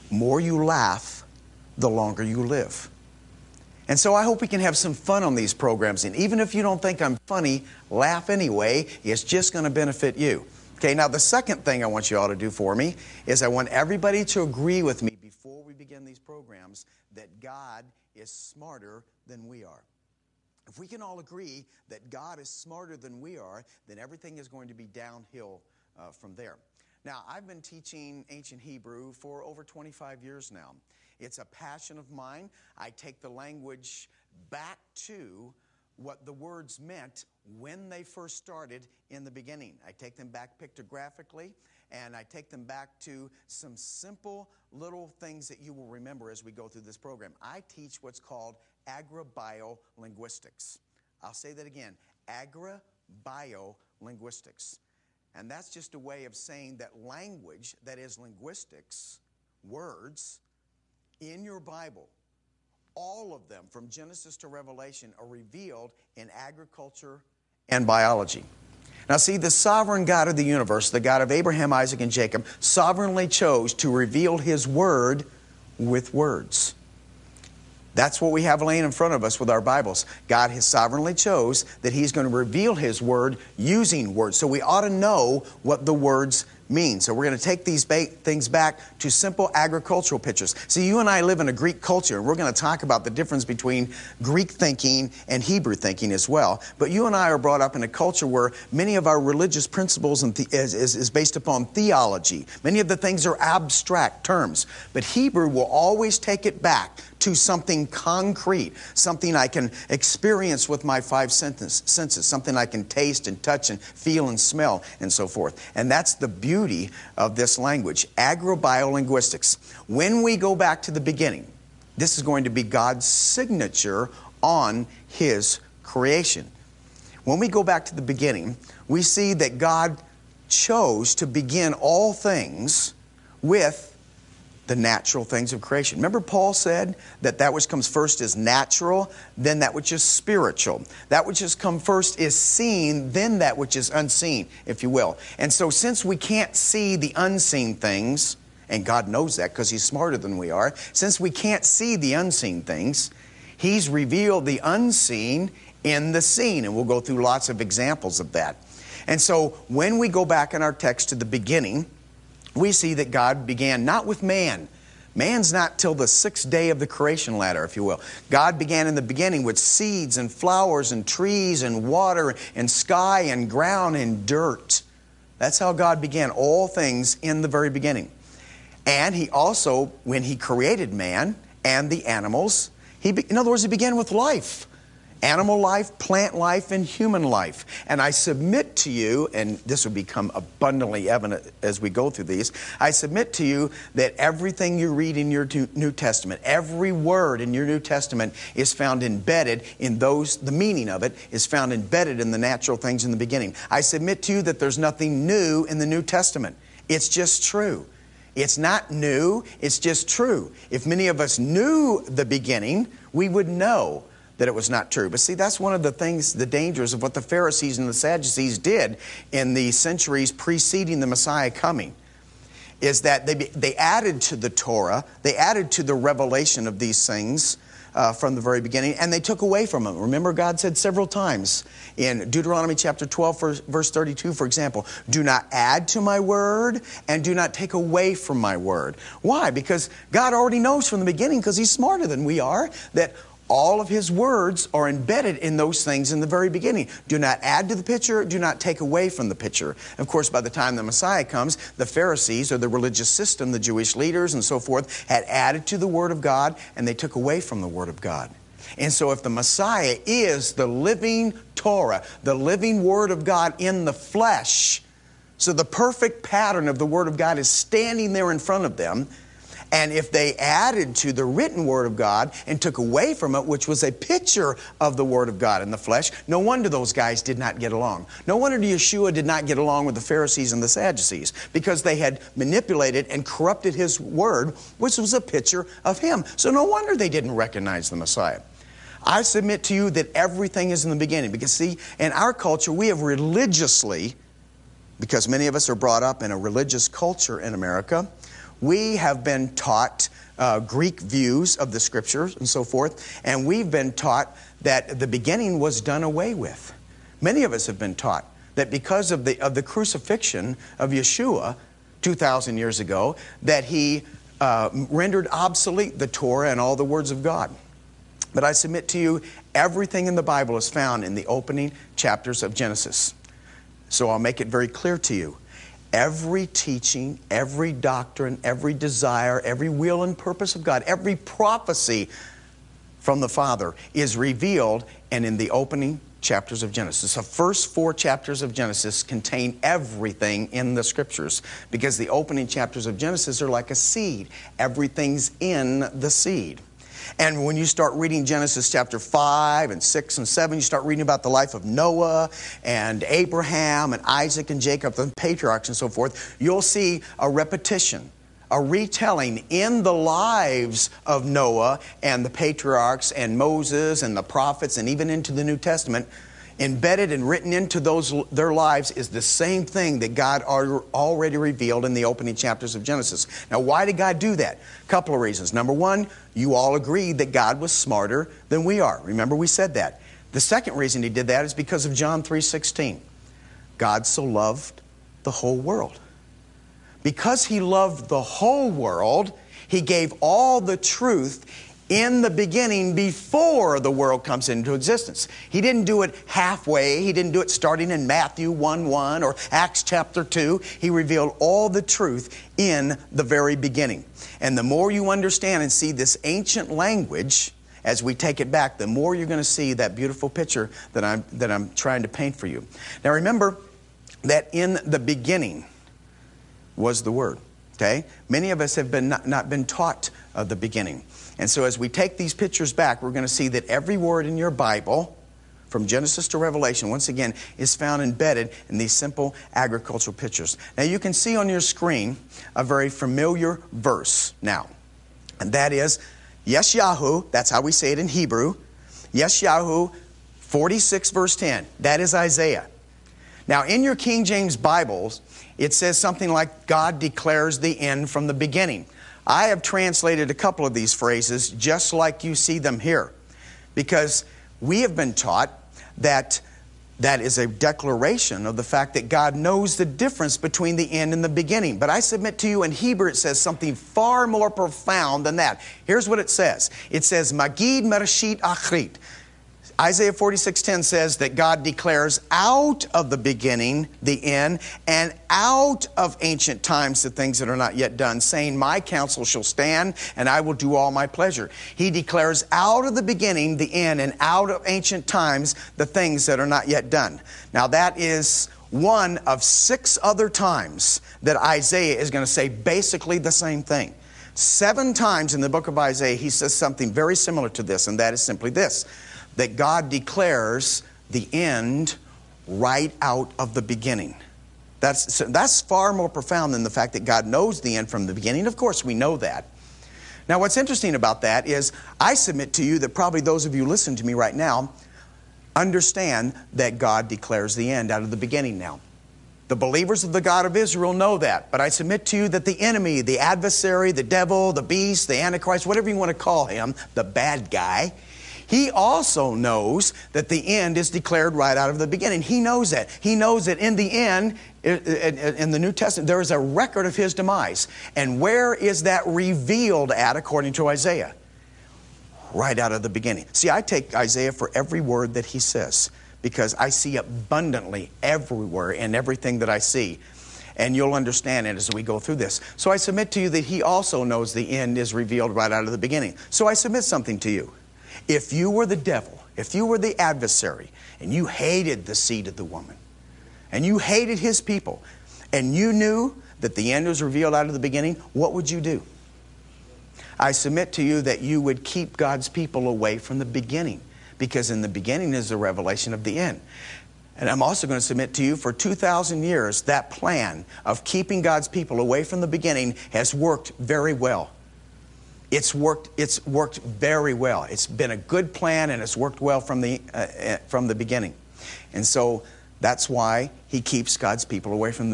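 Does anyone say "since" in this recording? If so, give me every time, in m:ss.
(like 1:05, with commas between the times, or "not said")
2:25, 2:30.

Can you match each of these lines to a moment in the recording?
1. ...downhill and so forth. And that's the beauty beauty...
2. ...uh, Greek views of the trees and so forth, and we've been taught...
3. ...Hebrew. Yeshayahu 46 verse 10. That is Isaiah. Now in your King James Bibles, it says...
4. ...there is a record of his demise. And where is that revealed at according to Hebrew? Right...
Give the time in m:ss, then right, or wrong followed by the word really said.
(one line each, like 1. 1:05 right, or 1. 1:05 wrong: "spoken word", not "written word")
1. 1:54 wrong: "smell", not "downhill"
2. 5:00 wrong: "scriptures", not "trees"
3. 7:18 right
4. 8:56 wrong: "Isaiah", not "Hebrew".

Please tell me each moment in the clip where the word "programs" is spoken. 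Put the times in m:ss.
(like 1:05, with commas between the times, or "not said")
0:05, 0:16, 0:46.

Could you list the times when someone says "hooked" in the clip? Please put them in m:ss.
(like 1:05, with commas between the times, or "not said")
not said.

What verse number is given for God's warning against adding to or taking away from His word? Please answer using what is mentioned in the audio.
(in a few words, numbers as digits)
32.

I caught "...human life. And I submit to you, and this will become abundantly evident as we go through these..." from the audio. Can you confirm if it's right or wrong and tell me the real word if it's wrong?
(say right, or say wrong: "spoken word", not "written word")
right.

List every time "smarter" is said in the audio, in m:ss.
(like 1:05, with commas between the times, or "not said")
0:18, 0:22, 2:29, 4:01, 6:17.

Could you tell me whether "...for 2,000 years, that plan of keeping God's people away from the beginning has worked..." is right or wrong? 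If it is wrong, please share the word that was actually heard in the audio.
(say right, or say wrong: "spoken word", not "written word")
right.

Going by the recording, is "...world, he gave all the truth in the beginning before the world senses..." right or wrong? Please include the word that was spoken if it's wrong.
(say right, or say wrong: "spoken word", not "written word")
wrong: "comes", not "senses".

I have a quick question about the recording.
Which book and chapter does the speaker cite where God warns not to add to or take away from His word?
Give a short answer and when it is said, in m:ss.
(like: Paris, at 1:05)
Deuteronomy 12, at 3:52.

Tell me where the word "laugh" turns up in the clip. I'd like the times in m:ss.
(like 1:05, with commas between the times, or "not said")
0:00, 0:07.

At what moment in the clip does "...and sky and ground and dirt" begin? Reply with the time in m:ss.
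2:52.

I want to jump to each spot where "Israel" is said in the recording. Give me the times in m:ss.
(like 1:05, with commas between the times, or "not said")
8:40.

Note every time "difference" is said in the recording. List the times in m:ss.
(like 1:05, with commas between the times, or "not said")
1:33, 7:39.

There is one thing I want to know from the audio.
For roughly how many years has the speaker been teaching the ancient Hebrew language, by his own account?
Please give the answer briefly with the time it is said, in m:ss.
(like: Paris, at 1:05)
over 25, at 0:29.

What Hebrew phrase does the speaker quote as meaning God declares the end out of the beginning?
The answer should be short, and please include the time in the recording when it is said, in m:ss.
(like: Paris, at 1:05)
magid mereshit achrit, at 7:47.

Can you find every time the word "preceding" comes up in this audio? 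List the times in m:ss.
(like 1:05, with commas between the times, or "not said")
3:40.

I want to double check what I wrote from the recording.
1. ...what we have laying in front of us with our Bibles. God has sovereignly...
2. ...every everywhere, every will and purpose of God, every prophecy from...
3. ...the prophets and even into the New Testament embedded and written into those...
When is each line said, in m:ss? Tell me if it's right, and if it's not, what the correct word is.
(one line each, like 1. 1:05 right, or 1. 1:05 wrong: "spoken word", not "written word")
1. 1:18 right
2. 5:28 wrong: "desire", not "everywhere"
3. 6:04 right.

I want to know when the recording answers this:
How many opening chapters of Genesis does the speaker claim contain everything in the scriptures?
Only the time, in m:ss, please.
5:37.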